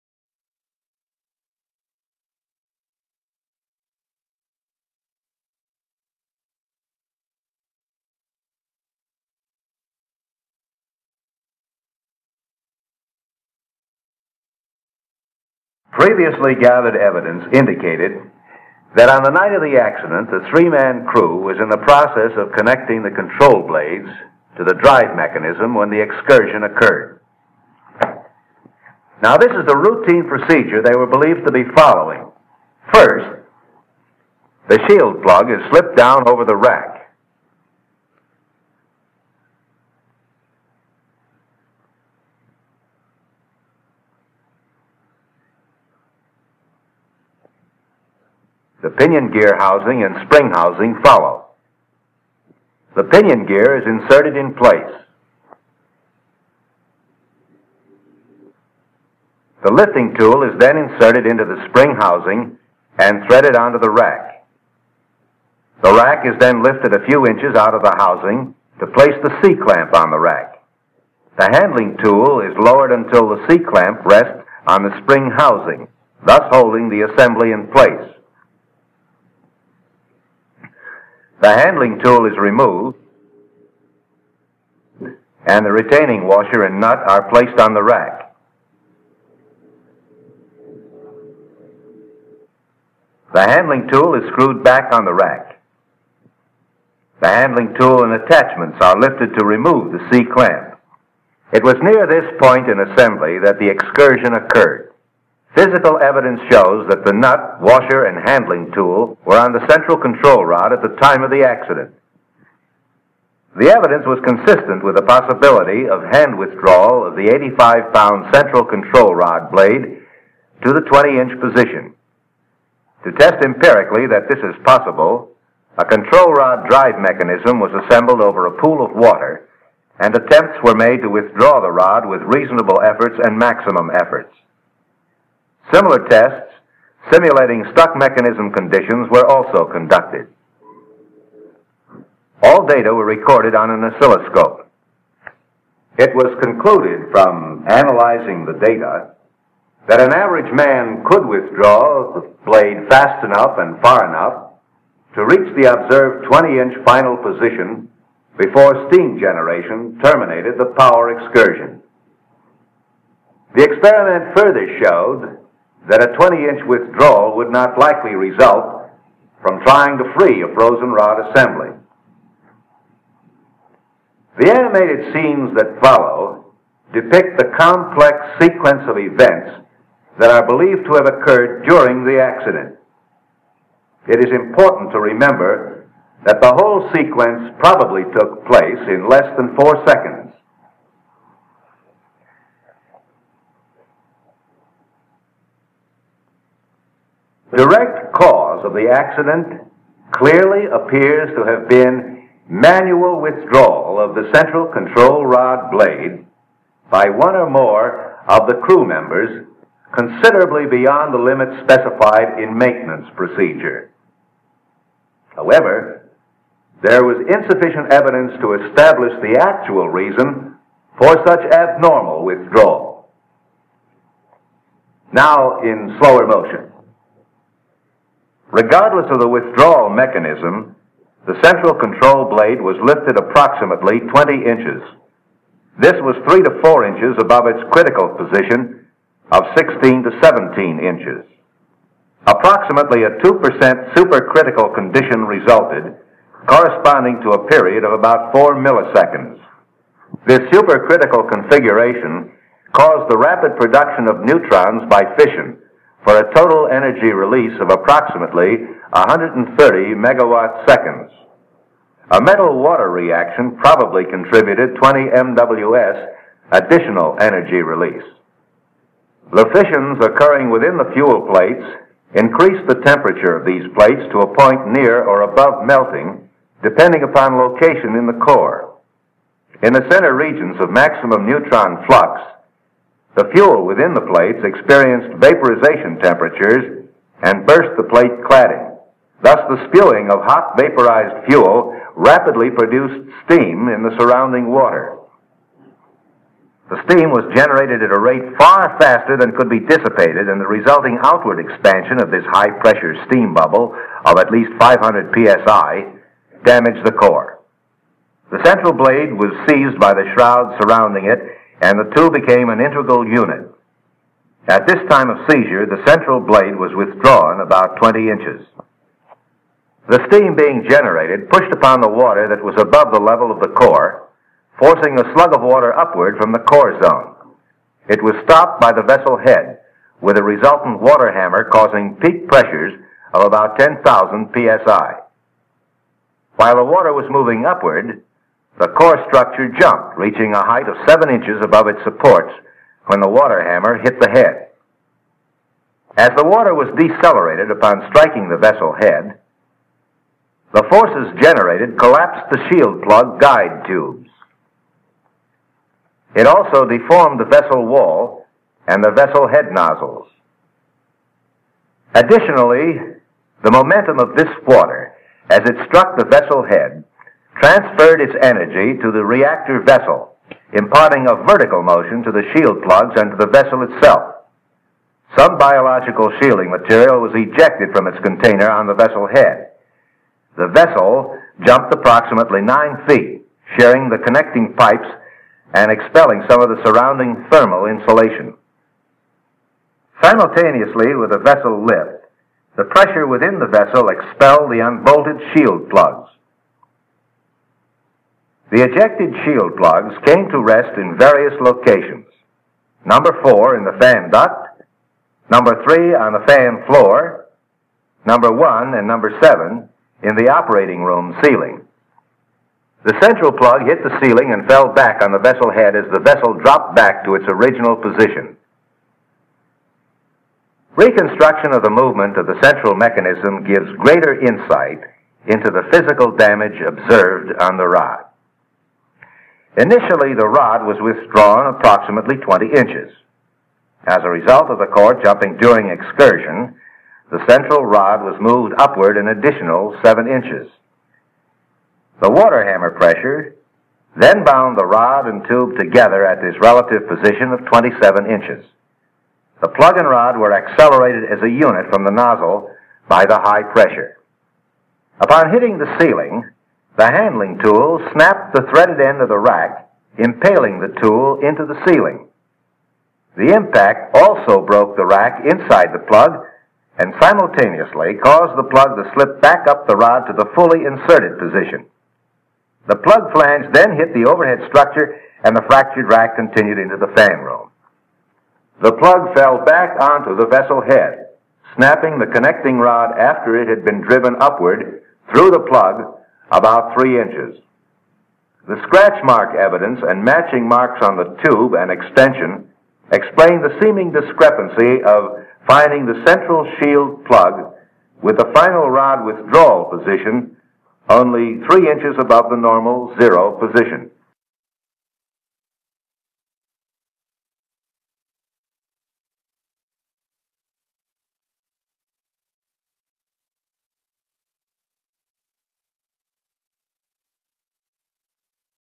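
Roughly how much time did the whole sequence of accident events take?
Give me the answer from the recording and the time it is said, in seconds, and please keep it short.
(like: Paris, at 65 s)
Less than 4 seconds, at 189 s.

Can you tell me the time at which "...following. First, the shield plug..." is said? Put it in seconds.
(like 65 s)
31 s.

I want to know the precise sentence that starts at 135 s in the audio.
Similar tests simulating stuck mechanism conditions were also conducted.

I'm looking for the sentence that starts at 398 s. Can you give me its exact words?
The ejected shield plugs came to rest in various locations.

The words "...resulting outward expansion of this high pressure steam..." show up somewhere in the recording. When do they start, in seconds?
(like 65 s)
300 s.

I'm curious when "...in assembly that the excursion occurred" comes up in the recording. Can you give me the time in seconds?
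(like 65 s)
102 s.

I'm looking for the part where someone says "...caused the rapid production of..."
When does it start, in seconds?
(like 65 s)
252 s.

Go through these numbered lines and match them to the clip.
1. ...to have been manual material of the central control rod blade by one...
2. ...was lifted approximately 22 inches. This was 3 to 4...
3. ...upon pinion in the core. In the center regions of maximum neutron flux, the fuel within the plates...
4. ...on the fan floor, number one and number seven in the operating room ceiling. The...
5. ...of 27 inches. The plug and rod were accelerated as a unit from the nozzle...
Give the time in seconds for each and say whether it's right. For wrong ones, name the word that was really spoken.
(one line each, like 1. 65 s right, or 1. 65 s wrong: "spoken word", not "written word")
1. 201 s wrong: "withdrawal", not "material"
2. 232 s wrong: "20", not "22"
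3. 277 s wrong: "location", not "pinion"
4. 405 s right
5. 447 s right.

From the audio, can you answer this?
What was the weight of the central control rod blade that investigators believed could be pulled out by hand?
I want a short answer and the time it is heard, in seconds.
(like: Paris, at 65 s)
85 pounds, at 117 s.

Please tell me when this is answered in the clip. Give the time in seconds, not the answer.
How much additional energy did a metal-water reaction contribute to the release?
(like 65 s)
264 s.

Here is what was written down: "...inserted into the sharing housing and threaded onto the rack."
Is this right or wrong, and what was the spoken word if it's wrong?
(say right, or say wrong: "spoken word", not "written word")
wrong: "spring", not "sharing".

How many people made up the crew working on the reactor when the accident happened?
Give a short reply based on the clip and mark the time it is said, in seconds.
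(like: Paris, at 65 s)
3, at 20 s.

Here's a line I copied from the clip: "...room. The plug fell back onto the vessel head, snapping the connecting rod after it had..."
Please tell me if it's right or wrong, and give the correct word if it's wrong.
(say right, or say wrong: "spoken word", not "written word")
right.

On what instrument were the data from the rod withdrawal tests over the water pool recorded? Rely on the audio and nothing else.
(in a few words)
An oscilloscope.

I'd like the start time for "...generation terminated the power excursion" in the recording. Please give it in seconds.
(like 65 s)
159 s.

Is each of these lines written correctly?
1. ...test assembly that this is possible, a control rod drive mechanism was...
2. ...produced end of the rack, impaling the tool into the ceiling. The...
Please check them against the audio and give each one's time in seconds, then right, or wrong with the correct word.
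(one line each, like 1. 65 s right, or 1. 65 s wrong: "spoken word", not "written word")
1. 123 s wrong: "empirically", not "assembly"
2. 458 s wrong: "threaded", not "produced".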